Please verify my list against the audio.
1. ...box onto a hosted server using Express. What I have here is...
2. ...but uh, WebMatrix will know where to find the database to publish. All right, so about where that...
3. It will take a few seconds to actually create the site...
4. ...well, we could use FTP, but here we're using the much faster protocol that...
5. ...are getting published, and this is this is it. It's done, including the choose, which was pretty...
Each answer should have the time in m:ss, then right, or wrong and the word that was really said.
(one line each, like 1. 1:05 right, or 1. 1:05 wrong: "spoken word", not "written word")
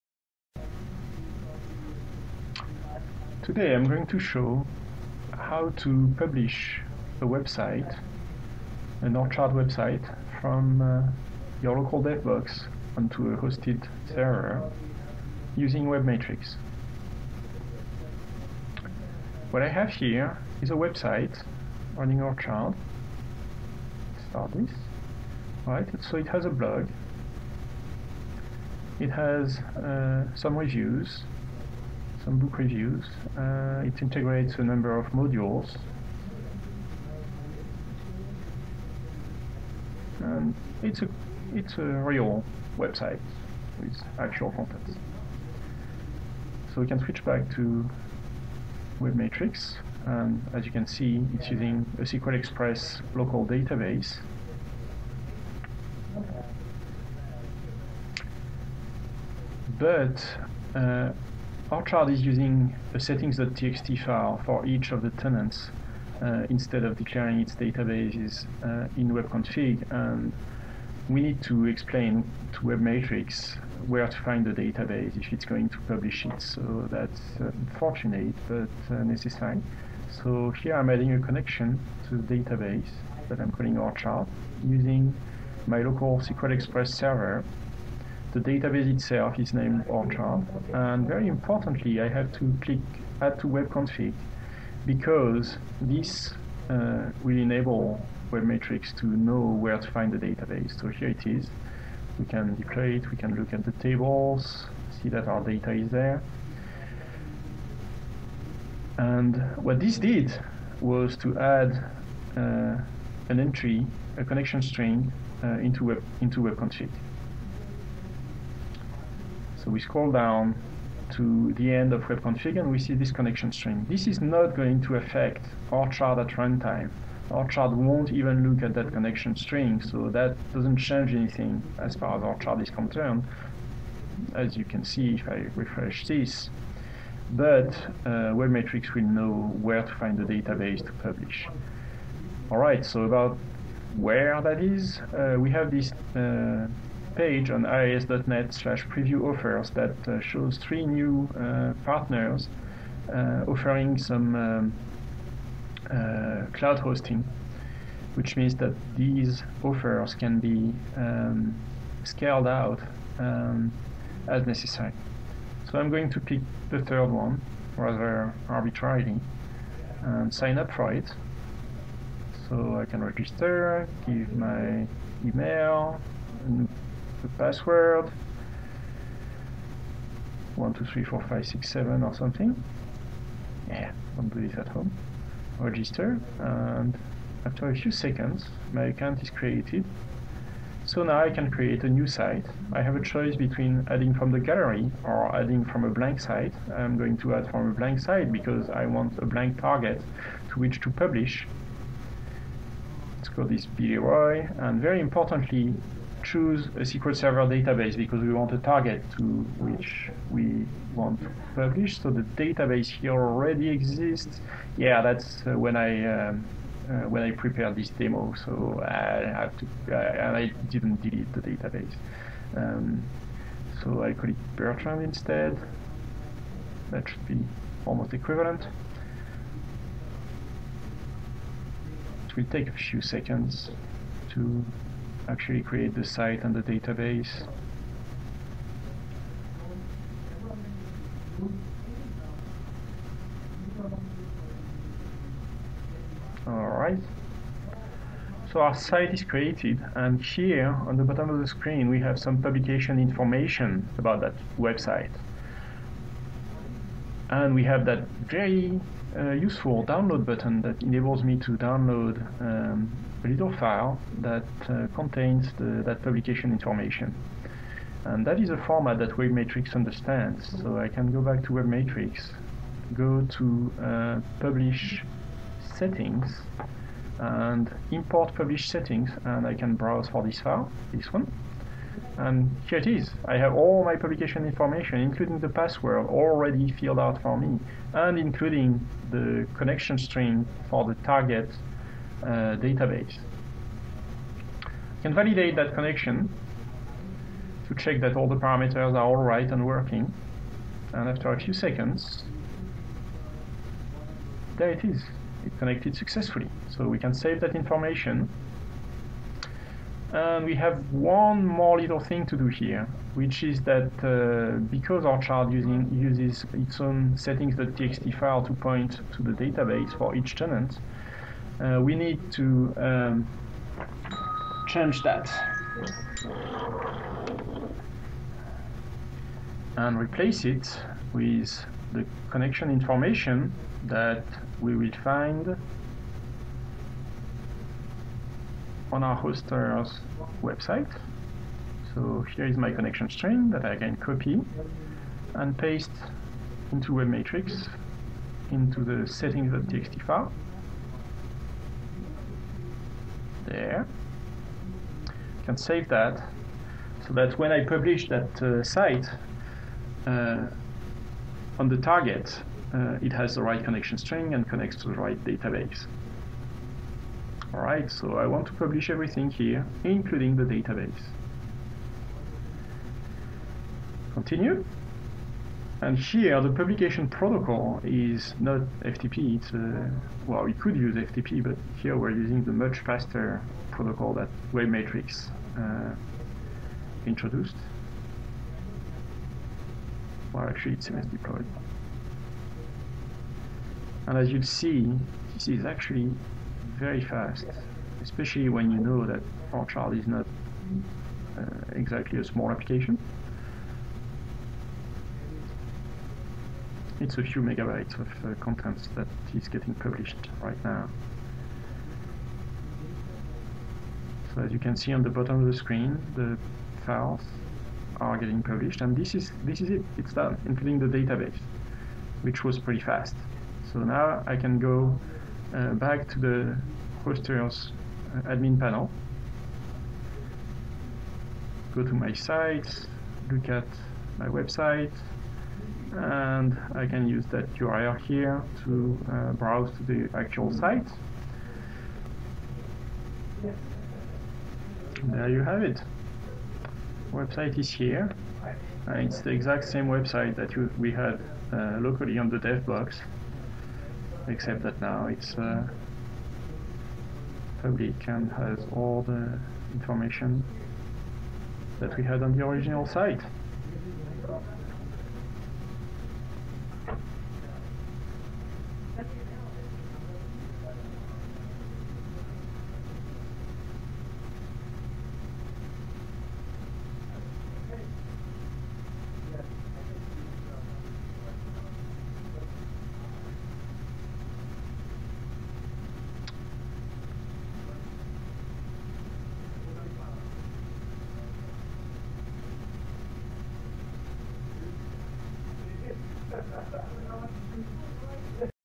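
1. 0:12 wrong: "WebMatrix", not "Express"
2. 2:17 right
3. 3:52 right
4. 6:20 right
5. 6:57 wrong: "database", not "choose".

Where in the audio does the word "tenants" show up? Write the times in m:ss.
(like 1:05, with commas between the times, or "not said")
1:05, 5:20.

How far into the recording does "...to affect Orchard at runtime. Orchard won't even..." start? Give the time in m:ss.
2:04.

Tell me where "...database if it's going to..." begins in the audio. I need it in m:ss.
1:14.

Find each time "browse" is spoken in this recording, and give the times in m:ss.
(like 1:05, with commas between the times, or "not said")
4:39, 7:19.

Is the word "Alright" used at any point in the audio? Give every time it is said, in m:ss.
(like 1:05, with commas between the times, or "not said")
4:06, 6:07.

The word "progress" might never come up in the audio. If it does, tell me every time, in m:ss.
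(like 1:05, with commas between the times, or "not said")
not said.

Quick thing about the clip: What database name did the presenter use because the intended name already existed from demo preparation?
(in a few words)
Bertrand.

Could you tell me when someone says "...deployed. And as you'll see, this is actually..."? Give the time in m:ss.
6:31.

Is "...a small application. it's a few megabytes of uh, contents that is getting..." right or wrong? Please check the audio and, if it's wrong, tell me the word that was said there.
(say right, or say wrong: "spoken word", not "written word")
right.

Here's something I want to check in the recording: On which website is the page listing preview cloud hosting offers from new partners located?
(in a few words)
iis.net.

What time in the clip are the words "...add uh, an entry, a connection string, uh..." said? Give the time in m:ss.
1:51.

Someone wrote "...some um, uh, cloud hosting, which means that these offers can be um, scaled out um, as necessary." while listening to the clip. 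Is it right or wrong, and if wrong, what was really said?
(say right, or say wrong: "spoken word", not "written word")
right.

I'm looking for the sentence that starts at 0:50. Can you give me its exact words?
And as you can see, it's using a SQL Express local database.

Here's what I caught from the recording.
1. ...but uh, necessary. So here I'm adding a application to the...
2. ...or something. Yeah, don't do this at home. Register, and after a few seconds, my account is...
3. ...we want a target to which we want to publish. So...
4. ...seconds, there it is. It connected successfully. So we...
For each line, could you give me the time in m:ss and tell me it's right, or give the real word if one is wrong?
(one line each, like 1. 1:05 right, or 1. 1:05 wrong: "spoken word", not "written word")
1. 1:18 wrong: "connection", not "application"
2. 3:02 right
3. 3:28 right
4. 5:01 right.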